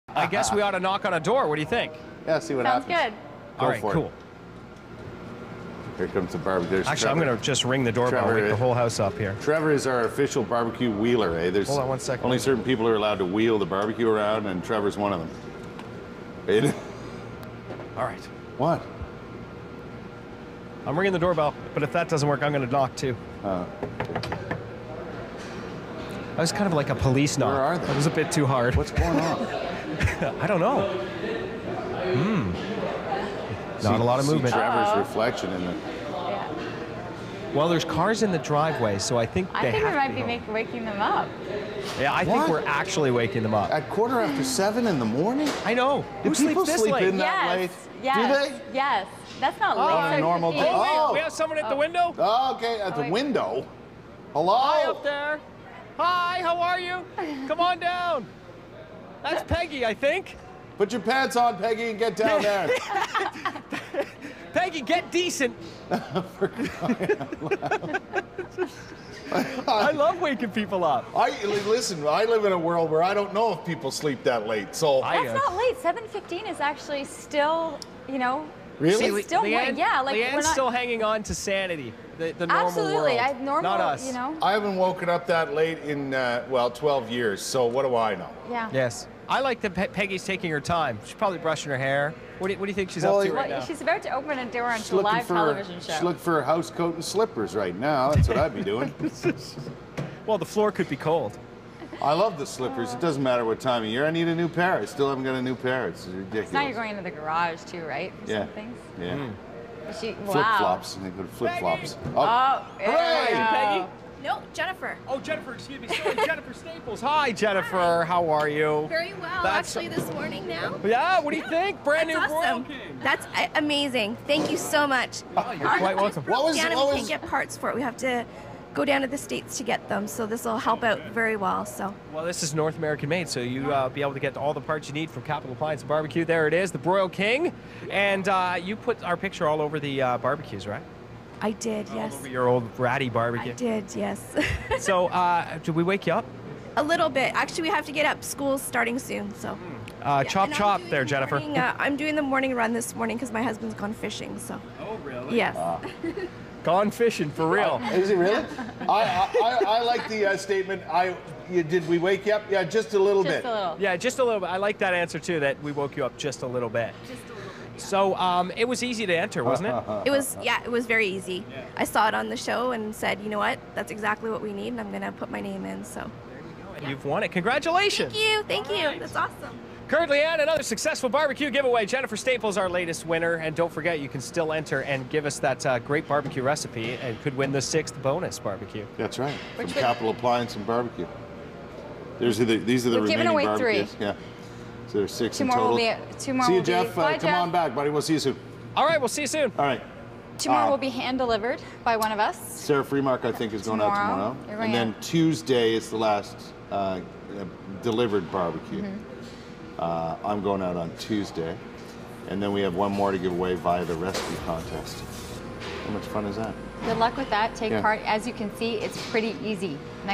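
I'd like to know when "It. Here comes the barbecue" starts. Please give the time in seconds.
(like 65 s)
4 s.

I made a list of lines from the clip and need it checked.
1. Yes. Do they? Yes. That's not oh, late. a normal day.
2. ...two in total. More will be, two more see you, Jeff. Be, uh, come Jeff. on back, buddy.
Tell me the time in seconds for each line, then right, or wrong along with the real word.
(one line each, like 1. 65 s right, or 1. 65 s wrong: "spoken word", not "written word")
1. 48 s right
2. 195 s right.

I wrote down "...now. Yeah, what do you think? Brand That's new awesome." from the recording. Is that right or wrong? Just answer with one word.
right.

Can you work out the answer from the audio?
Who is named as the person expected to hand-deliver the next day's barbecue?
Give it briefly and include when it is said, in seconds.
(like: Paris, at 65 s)
Sarah Freemark, at 202 s.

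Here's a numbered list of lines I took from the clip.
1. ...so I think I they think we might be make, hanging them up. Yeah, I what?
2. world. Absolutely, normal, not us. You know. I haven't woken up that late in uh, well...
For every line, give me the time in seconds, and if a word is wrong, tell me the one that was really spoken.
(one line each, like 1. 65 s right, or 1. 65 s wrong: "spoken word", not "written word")
1. 38 s wrong: "waking", not "hanging"
2. 83 s right.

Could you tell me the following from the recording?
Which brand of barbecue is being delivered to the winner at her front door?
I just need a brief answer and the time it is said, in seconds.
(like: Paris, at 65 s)
Broil King, at 136 s.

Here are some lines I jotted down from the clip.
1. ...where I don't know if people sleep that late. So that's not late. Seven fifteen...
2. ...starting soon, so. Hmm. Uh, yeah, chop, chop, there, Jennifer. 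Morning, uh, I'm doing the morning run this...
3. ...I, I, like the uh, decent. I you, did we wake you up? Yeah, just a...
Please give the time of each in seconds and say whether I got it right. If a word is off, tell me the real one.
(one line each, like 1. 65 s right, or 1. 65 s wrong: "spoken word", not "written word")
1. 72 s right
2. 148 s right
3. 159 s wrong: "statement", not "decent".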